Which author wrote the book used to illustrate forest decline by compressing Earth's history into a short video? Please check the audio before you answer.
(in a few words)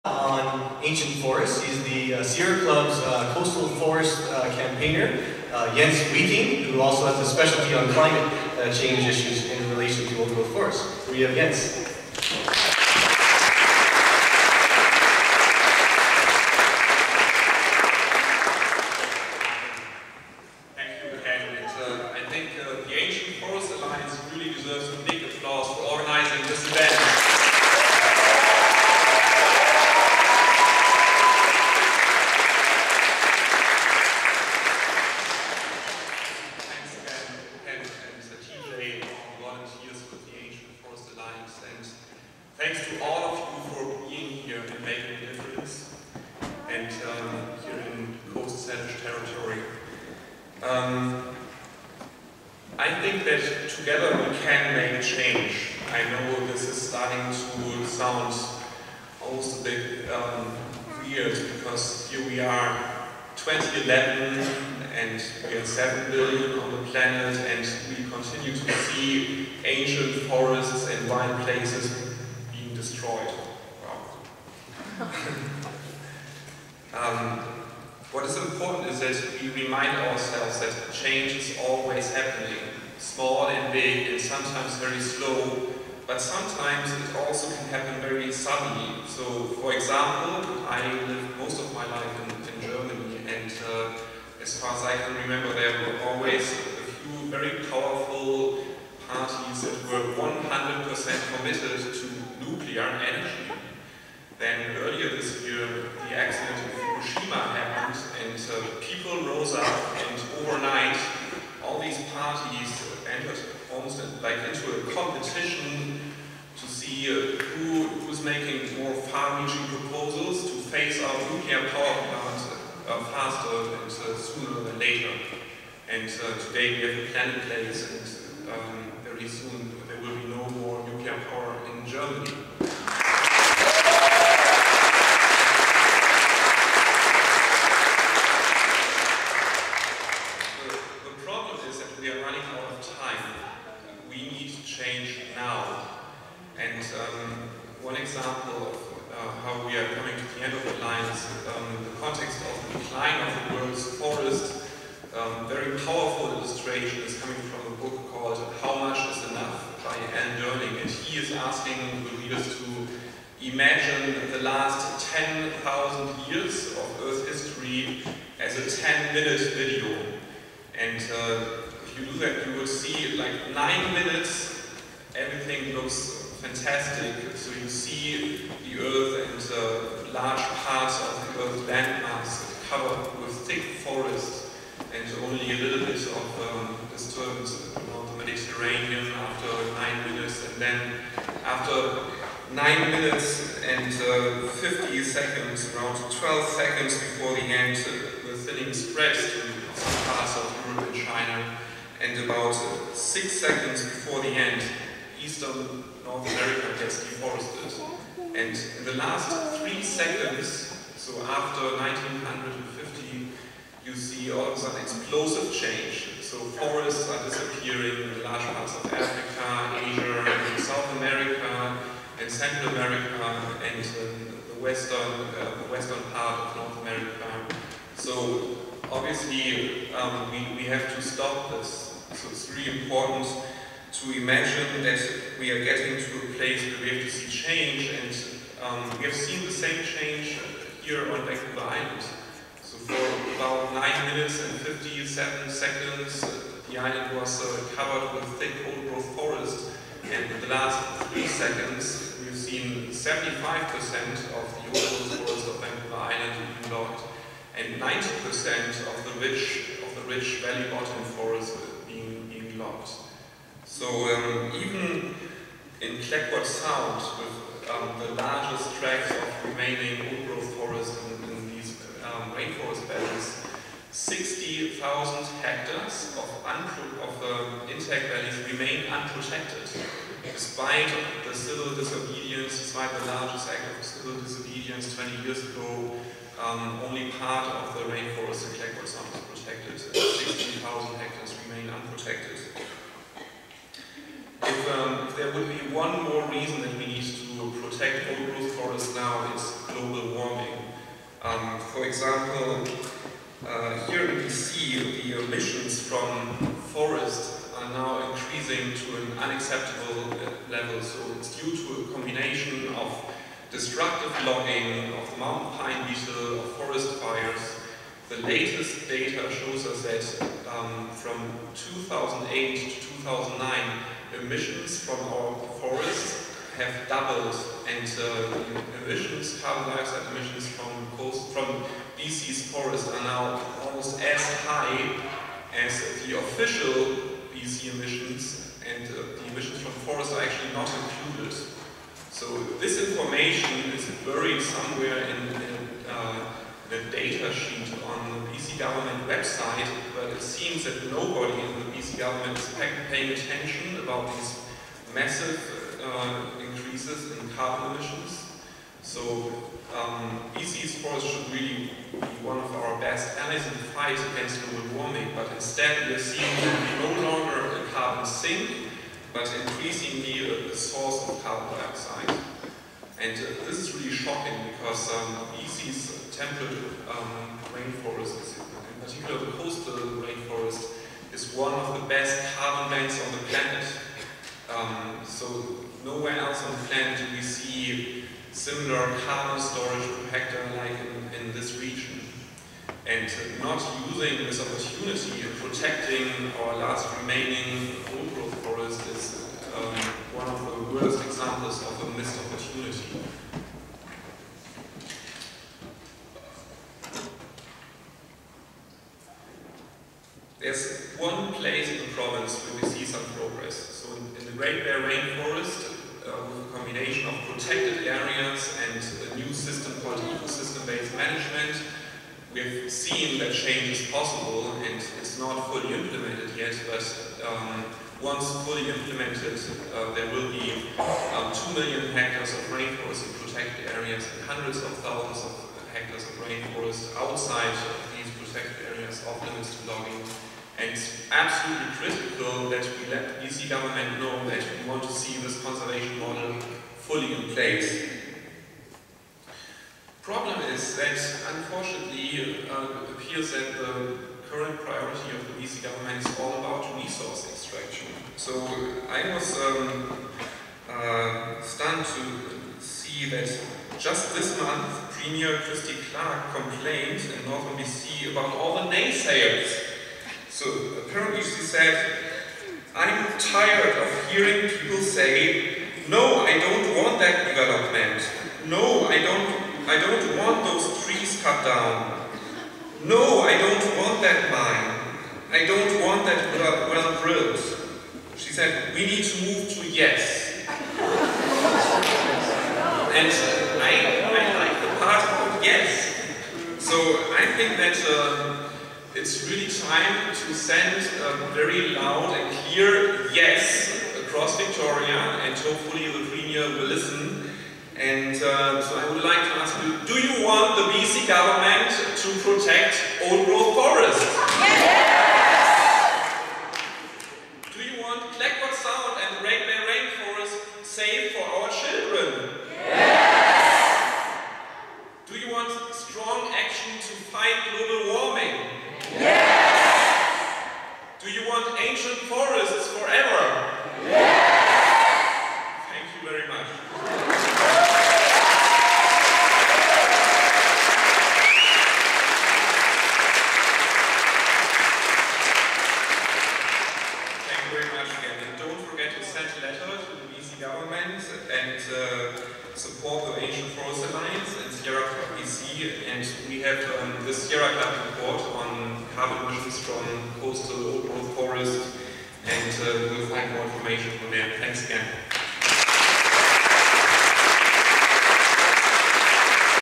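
Alan Durning.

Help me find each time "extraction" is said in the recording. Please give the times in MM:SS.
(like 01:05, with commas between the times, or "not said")
07:37.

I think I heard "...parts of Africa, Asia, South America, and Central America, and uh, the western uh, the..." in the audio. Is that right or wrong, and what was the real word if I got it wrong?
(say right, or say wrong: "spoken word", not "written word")
right.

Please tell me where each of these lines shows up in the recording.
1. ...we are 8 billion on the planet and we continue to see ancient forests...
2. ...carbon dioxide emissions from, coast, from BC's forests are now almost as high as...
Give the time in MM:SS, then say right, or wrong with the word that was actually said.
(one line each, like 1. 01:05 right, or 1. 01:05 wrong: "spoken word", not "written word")
1. 01:05 wrong: "7", not "8"
2. 05:29 right.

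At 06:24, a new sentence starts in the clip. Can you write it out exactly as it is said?
Um, so nowhere else on the planet do we see similar carbon storage per hectare like in, in this region.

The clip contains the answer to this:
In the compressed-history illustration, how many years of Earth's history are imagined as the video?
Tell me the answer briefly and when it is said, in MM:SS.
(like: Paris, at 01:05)
10,000, at 02:45.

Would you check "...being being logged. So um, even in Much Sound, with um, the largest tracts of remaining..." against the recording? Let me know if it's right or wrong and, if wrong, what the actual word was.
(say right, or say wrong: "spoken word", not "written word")
wrong: "Clayoquot", not "Much".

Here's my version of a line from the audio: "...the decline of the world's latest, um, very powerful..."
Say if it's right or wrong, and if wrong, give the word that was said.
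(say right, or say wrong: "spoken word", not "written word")
wrong: "forest", not "latest".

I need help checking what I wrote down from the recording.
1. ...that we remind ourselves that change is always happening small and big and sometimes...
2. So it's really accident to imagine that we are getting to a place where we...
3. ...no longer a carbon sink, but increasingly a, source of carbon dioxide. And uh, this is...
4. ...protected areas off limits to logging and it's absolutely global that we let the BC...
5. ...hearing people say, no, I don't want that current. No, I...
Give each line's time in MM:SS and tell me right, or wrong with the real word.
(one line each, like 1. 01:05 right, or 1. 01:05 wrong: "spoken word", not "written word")
1. 01:18 right
2. 03:52 wrong: "important", not "accident"
3. 06:06 right
4. 07:18 wrong: "critical", not "global"
5. 07:54 wrong: "development", not "current".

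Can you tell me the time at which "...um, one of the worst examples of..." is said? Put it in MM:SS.
06:39.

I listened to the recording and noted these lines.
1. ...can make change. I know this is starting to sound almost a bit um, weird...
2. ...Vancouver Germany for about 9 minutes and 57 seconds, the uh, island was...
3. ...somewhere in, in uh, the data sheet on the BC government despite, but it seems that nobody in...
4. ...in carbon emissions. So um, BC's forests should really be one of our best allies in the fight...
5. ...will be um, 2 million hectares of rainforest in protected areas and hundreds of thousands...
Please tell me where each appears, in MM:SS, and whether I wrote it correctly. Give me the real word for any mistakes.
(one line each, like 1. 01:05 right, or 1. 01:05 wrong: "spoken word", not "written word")
1. 00:54 right
2. 04:01 wrong: "Island", not "Germany"
3. 05:44 wrong: "website", not "despite"
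4. 05:57 right
5. 07:10 right.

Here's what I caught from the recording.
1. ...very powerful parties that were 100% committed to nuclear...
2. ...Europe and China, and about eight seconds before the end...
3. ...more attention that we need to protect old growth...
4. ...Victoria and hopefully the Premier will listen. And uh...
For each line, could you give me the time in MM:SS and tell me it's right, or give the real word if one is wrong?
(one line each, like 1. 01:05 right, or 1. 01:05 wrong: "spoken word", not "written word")
1. 01:37 right
2. 03:20 wrong: "six", not "eight"
3. 04:56 wrong: "reason", not "attention"
4. 08:24 right.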